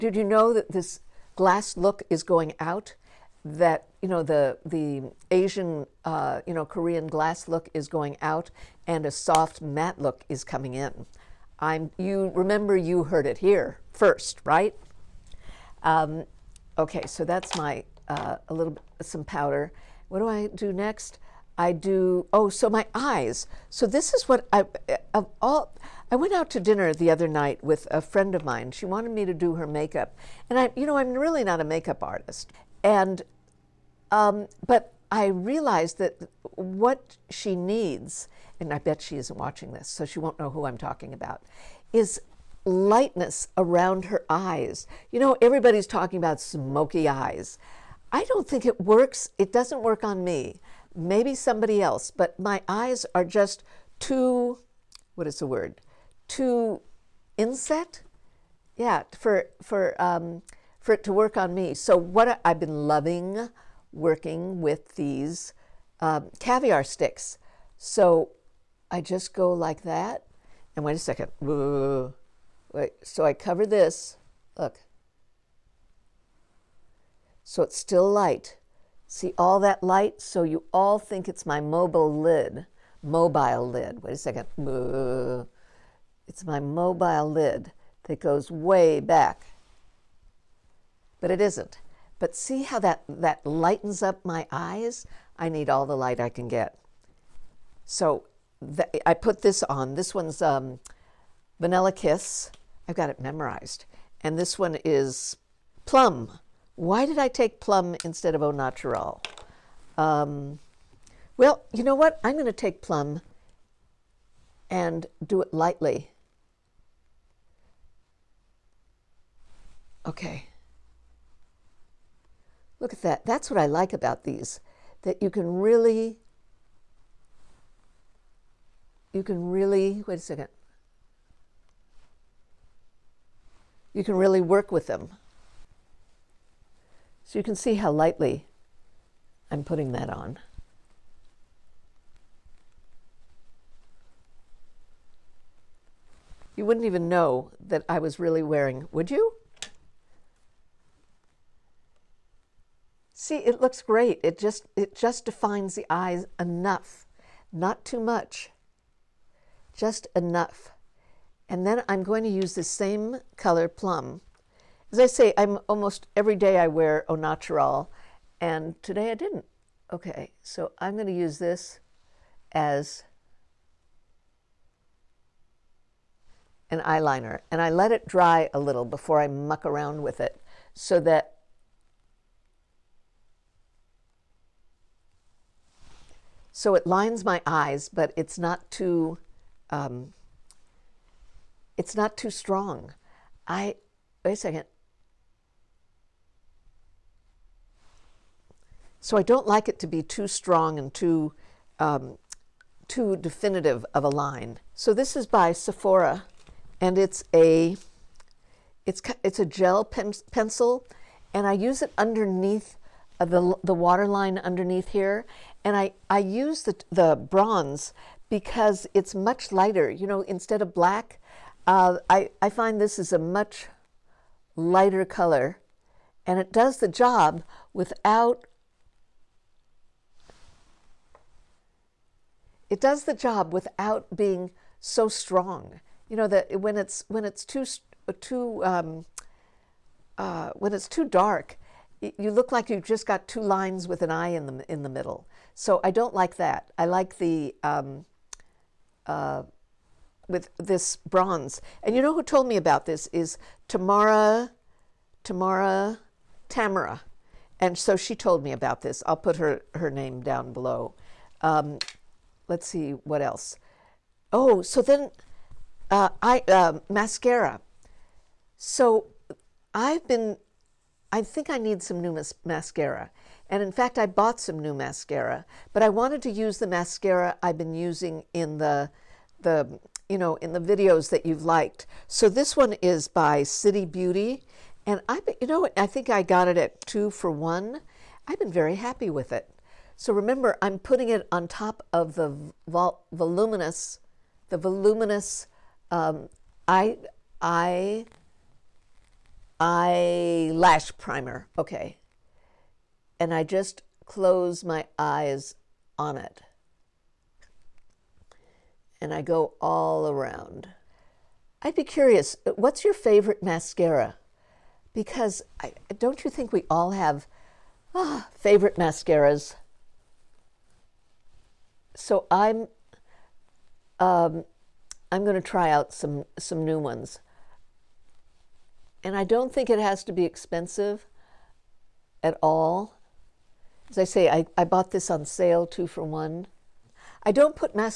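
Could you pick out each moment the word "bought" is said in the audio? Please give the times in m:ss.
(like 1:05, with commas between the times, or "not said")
4:34, 5:34.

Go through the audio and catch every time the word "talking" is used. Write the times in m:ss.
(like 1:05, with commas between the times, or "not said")
0:40, 0:45.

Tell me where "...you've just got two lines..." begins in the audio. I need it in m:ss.
4:02.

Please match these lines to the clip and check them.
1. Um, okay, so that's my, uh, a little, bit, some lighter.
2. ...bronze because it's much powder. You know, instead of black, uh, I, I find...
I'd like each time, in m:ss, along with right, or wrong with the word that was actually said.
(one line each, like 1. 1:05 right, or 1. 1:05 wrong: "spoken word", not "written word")
1. 0:15 wrong: "powder", not "lighter"
2. 3:37 wrong: "lighter", not "powder".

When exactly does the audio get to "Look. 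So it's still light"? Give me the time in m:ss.
1:14.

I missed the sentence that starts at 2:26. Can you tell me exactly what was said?
You wouldn't even know that I was really wearing, would you?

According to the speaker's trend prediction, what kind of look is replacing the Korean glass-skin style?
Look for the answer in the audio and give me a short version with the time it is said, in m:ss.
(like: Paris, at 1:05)
soft matte, at 0:09.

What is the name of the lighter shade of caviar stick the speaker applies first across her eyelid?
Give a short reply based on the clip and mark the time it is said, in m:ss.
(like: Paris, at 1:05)
Vanilla Kiss, at 1:41.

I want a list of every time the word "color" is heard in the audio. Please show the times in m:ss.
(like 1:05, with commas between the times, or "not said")
2:43, 3:45.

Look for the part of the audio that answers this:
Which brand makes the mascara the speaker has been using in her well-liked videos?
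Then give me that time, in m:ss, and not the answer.
4:43.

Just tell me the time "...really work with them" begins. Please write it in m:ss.
2:14.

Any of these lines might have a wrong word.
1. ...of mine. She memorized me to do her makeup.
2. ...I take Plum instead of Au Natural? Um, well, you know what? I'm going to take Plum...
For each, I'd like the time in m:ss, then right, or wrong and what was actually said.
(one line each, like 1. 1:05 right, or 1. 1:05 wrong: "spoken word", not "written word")
1. 0:28 wrong: "wanted", not "memorized"
2. 1:47 right.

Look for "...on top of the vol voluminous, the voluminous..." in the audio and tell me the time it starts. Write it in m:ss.
4:51.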